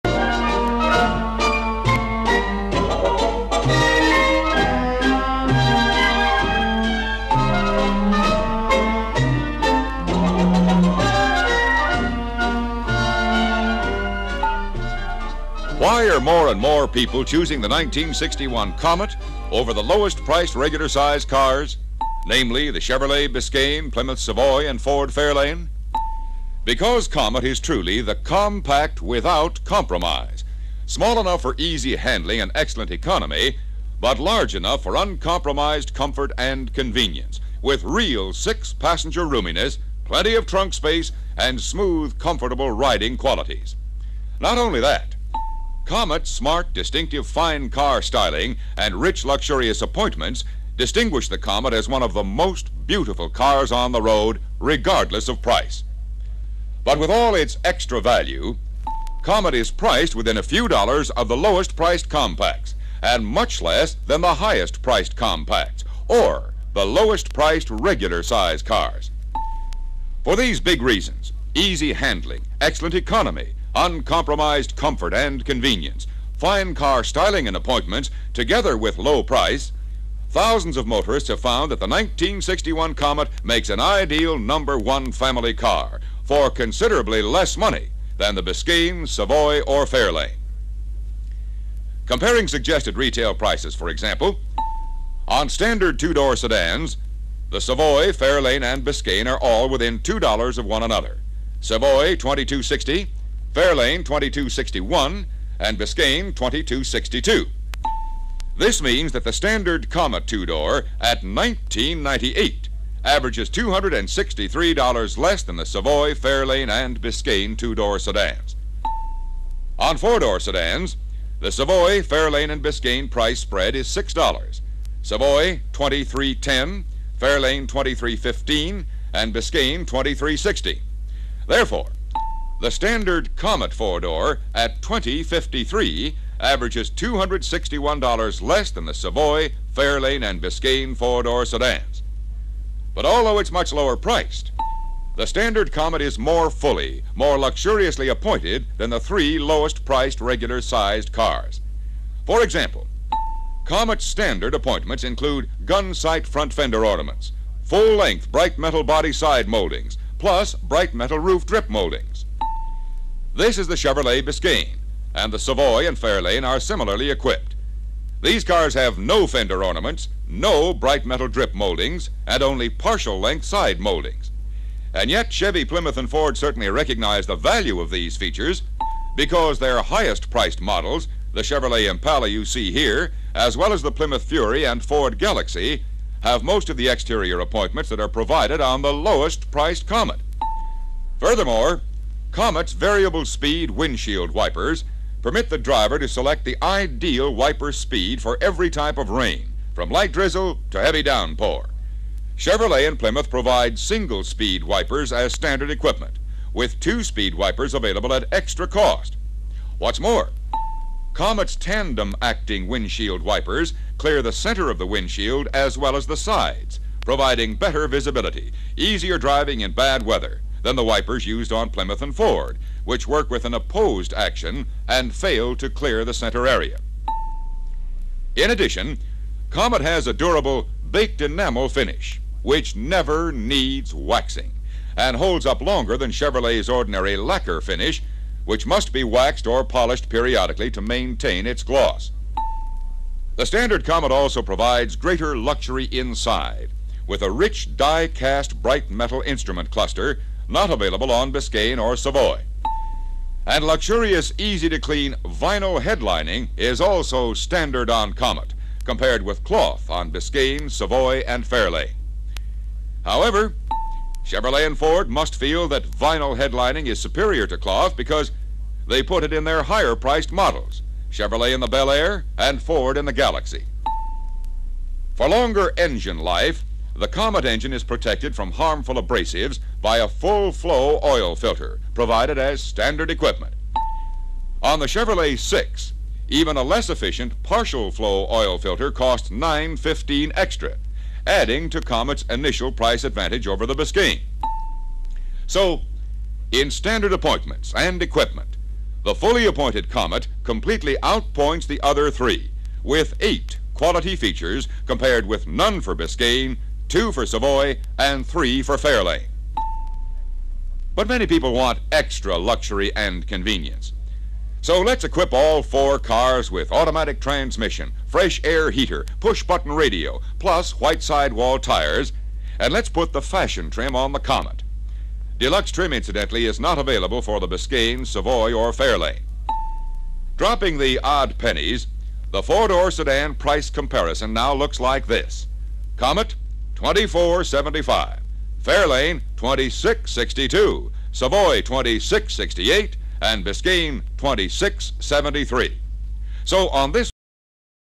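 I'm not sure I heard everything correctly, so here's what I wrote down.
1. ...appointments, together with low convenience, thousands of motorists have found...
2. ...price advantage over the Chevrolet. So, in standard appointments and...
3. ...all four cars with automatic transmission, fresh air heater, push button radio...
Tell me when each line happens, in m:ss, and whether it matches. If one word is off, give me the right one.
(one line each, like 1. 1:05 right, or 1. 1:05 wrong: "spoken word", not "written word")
1. 1:17 wrong: "price", not "convenience"
2. 4:52 wrong: "Biscayne", not "Chevrolet"
3. 5:15 right.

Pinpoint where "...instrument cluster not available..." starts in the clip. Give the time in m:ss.
4:09.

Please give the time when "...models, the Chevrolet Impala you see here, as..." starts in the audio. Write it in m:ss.
3:00.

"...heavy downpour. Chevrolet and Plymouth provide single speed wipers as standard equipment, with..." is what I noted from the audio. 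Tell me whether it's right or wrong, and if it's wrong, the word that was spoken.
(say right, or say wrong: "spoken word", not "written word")
right.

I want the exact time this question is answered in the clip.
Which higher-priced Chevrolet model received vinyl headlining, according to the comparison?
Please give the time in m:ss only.
4:31.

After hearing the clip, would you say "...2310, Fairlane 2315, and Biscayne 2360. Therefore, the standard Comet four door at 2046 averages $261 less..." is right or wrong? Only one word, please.
wrong.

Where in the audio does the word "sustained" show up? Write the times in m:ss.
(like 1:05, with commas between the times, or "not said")
not said.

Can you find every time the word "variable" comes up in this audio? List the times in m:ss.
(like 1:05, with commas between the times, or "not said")
3:12.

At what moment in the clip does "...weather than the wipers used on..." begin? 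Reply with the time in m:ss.
3:40.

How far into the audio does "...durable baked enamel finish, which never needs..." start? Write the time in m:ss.
3:50.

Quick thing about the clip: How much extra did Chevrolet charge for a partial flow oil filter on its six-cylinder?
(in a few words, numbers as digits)
9.15.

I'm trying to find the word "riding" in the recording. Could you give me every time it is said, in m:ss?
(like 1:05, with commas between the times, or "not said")
0:42.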